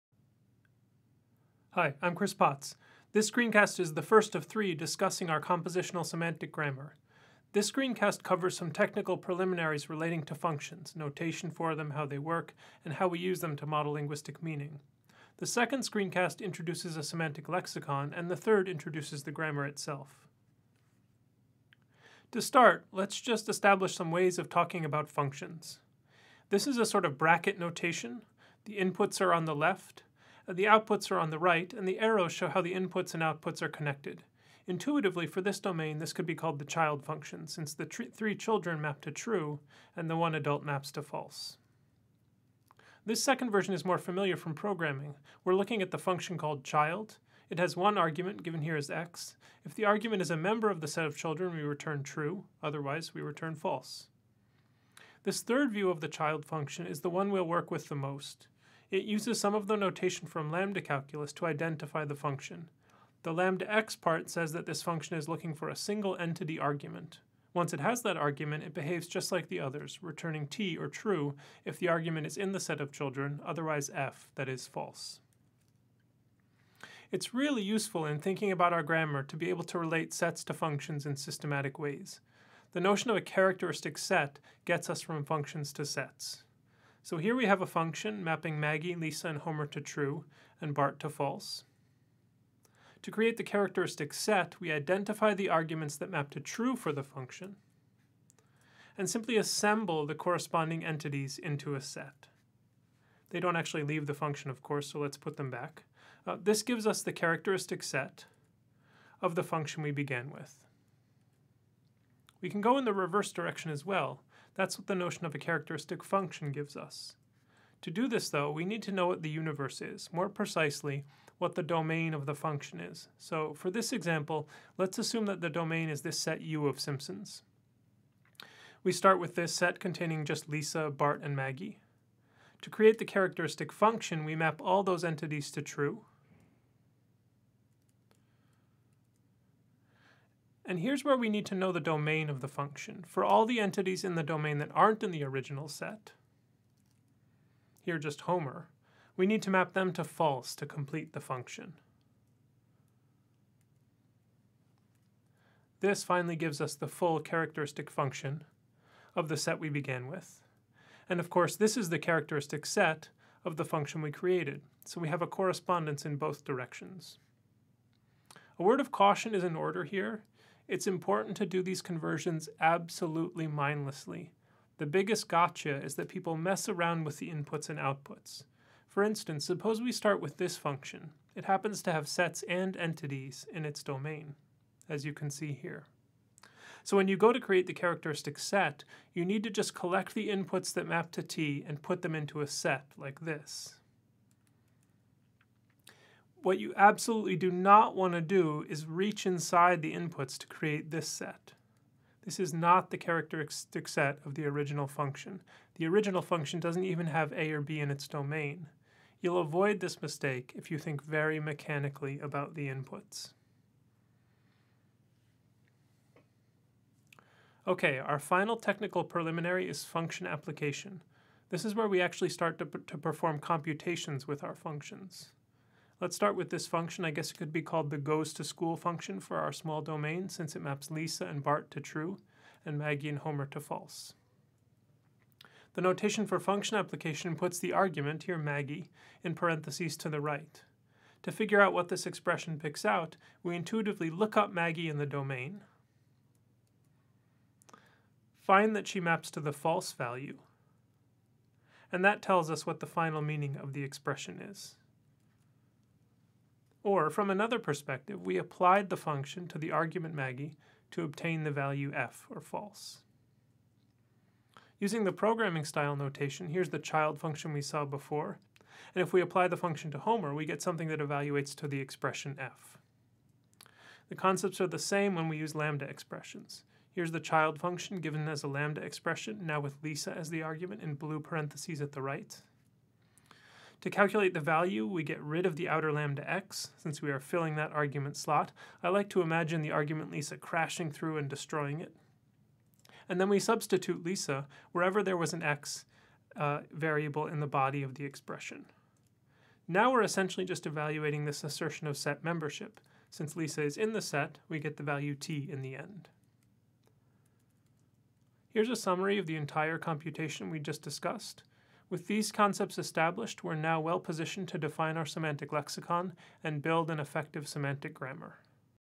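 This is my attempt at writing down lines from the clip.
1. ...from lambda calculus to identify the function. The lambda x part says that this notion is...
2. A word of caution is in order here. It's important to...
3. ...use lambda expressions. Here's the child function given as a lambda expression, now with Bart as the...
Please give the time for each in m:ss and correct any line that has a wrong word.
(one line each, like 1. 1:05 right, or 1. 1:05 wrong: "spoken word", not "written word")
1. 1:00 wrong: "function", not "notion"
2. 2:48 right
3. 4:35 wrong: "Lisa", not "Bart".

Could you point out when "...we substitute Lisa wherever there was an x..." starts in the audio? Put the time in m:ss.
4:53.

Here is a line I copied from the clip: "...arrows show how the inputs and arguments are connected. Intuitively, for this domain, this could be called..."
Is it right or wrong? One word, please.
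wrong.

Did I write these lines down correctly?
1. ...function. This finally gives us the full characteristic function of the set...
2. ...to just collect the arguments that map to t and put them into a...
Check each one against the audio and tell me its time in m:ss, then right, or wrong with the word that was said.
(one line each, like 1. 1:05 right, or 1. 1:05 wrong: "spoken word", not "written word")
1. 2:31 right
2. 3:09 wrong: "inputs", not "arguments".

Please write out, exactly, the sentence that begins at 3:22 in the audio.
This is not the characteristic set of the original function.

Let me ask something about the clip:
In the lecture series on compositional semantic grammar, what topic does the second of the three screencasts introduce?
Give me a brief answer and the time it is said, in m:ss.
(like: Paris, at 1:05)
A semantic lexicon, at 0:16.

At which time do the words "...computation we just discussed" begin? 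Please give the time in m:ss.
5:09.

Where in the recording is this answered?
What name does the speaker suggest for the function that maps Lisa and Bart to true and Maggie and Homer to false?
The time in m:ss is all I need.
3:47.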